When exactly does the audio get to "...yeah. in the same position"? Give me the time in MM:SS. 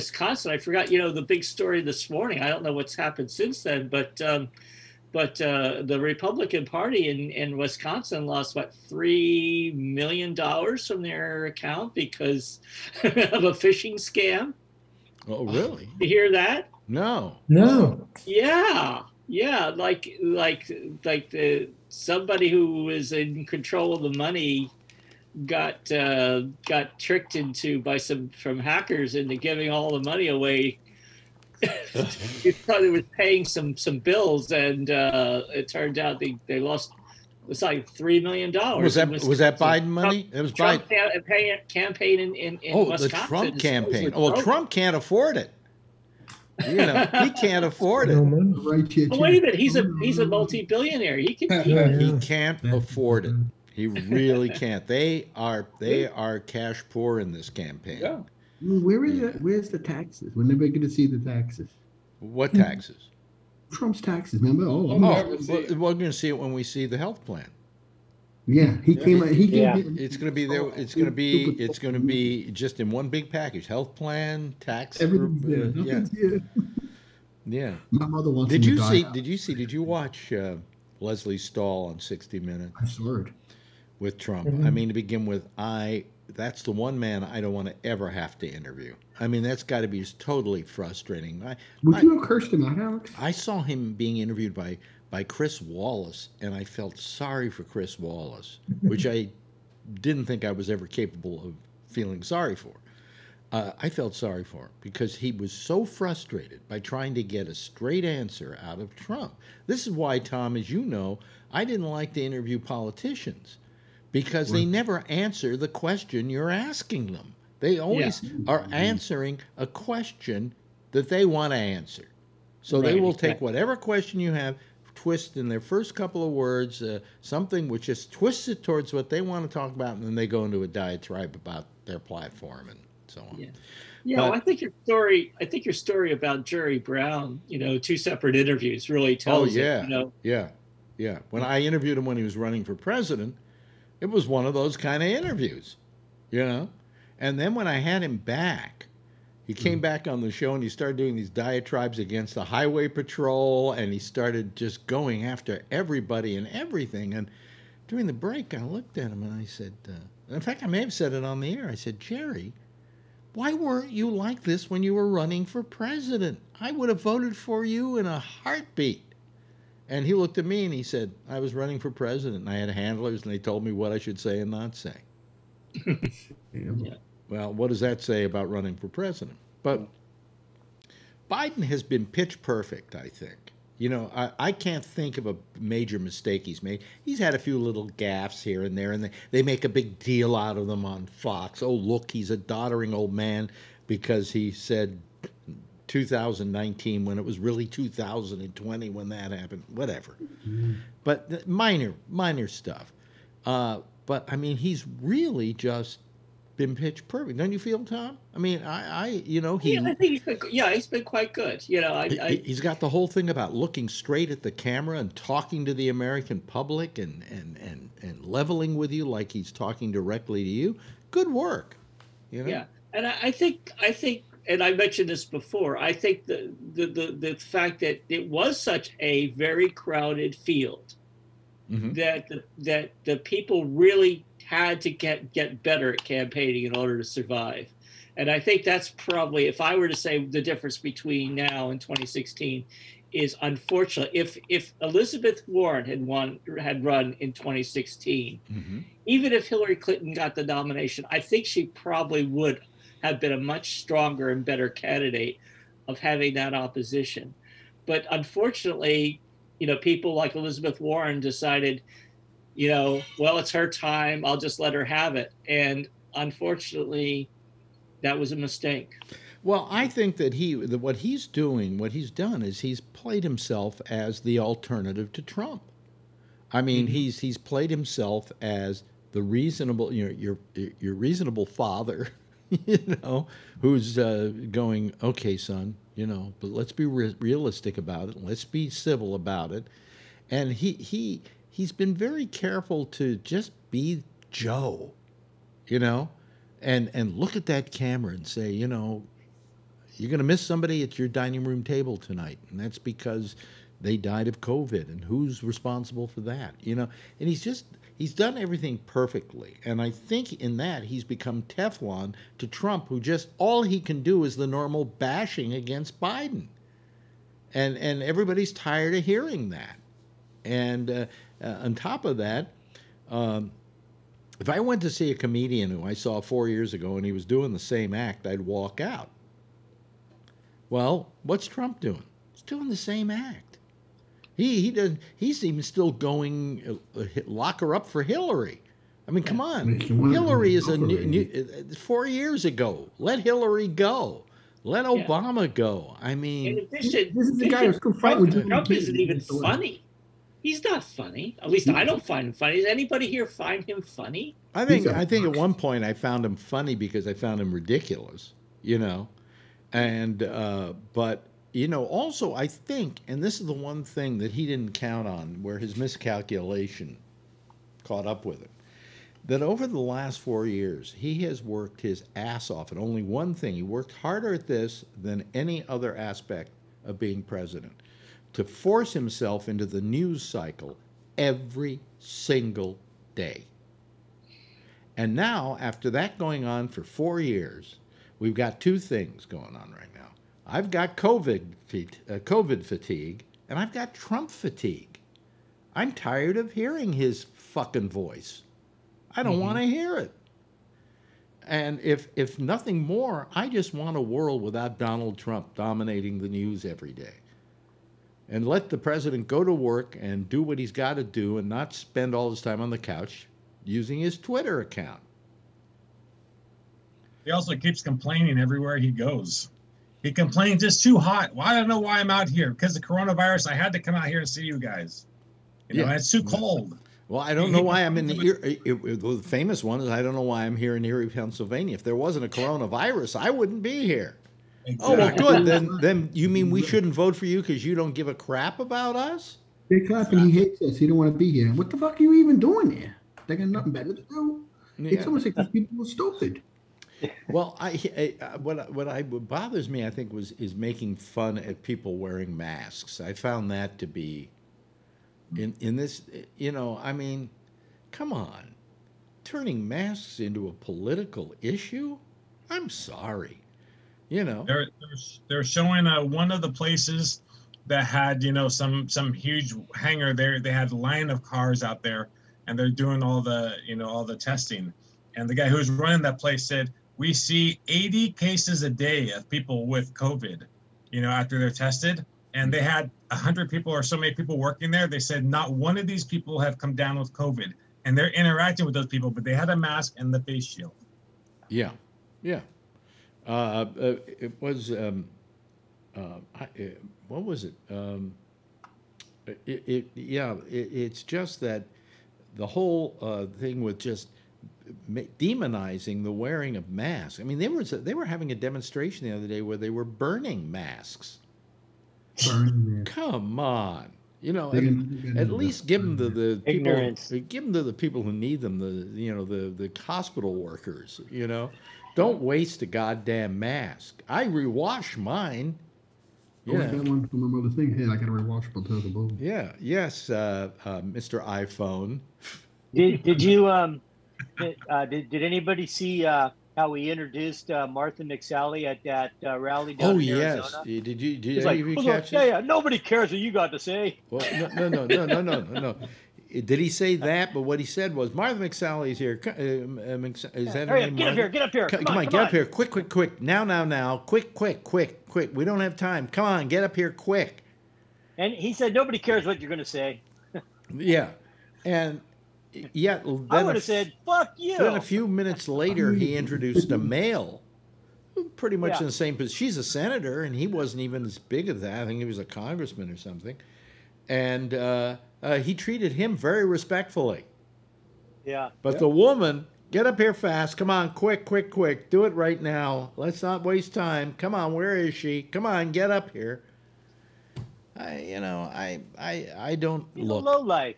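09:28.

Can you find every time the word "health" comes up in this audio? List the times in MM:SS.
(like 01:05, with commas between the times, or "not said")
01:06, 01:13.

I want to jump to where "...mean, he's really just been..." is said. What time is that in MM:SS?
03:24.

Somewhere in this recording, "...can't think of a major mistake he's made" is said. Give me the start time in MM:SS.
03:04.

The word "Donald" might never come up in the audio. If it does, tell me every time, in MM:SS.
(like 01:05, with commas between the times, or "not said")
06:44.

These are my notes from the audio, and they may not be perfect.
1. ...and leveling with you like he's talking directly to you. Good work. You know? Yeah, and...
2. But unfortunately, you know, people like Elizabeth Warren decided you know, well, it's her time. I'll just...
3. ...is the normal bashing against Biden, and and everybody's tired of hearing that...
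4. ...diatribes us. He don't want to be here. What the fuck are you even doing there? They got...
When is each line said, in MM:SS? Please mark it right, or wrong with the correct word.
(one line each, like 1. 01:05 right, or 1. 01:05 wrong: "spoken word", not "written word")
1. 03:38 right
2. 04:17 right
3. 05:14 right
4. 07:20 wrong: "hates", not "diatribes".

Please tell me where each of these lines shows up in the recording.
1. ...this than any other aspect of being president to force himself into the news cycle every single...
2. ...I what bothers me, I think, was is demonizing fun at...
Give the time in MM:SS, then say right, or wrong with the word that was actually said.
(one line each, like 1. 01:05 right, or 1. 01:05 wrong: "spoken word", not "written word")
1. 06:14 right
2. 07:28 wrong: "making", not "demonizing".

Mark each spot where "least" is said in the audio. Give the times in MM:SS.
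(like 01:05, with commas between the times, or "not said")
05:51, 08:35.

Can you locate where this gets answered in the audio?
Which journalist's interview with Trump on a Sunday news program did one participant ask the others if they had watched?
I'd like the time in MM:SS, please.
01:21.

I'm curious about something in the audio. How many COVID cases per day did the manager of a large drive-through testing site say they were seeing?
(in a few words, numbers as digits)
80.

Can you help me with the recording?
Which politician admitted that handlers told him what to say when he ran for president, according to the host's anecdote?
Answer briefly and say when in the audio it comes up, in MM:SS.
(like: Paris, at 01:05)
Jerry Brown, at 02:16.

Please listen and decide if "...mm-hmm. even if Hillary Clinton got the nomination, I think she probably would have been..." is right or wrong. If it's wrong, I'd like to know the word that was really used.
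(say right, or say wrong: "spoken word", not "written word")
right.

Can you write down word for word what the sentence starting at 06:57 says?
He also keeps complaining everywhere he goes.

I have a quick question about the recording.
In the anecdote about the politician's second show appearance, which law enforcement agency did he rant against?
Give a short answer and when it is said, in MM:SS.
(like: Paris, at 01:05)
highway patrol, at 02:32.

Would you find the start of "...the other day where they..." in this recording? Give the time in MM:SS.
08:29.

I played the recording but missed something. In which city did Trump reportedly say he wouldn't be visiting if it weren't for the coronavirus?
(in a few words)
Erie, Pennsylvania.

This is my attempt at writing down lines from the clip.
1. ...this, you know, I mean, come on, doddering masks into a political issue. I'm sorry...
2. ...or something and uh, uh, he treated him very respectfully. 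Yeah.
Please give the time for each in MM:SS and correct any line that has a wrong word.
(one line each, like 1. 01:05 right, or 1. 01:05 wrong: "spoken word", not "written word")
1. 07:35 wrong: "turning", not "doddering"
2. 09:32 right.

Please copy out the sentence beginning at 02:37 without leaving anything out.
And during the break, I looked at him and I said, uh, in fact, I may have said it on the air.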